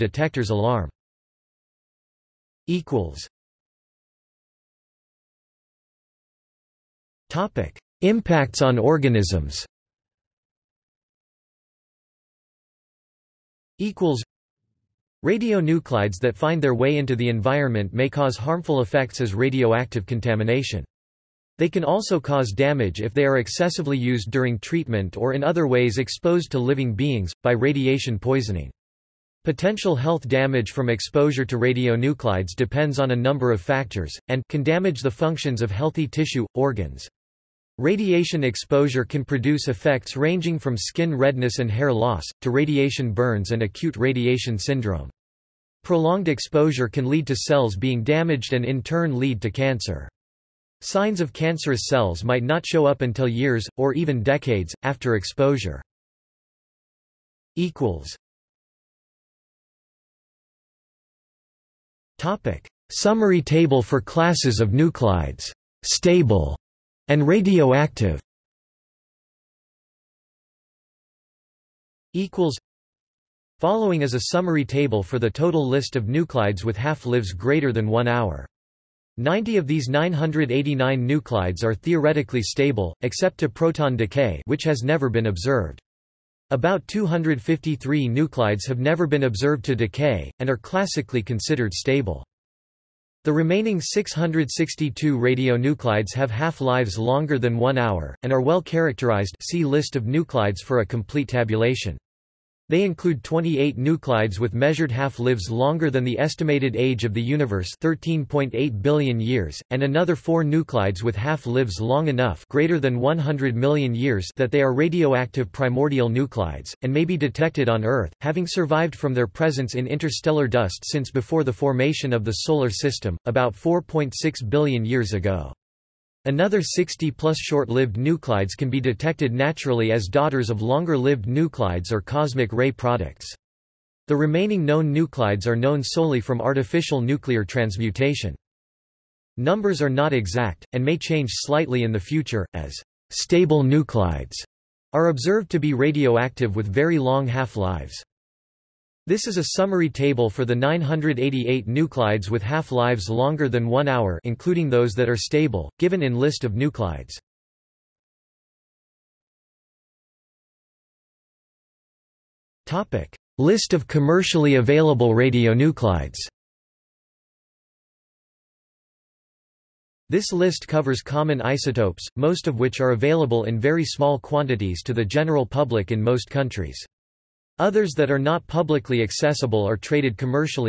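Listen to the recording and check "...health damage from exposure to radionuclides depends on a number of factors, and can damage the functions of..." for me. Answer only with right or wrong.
right.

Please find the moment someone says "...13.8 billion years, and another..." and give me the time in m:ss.
1:47.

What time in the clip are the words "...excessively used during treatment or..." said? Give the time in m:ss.
0:23.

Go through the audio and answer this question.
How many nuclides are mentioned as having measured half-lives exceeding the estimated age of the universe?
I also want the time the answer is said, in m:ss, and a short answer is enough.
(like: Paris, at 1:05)
28, at 1:43.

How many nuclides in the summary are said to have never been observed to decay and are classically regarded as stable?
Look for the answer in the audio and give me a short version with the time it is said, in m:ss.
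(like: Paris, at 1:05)
253, at 1:26.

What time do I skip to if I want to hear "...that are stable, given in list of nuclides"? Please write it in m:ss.
2:34.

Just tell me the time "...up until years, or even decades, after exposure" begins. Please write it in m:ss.
0:52.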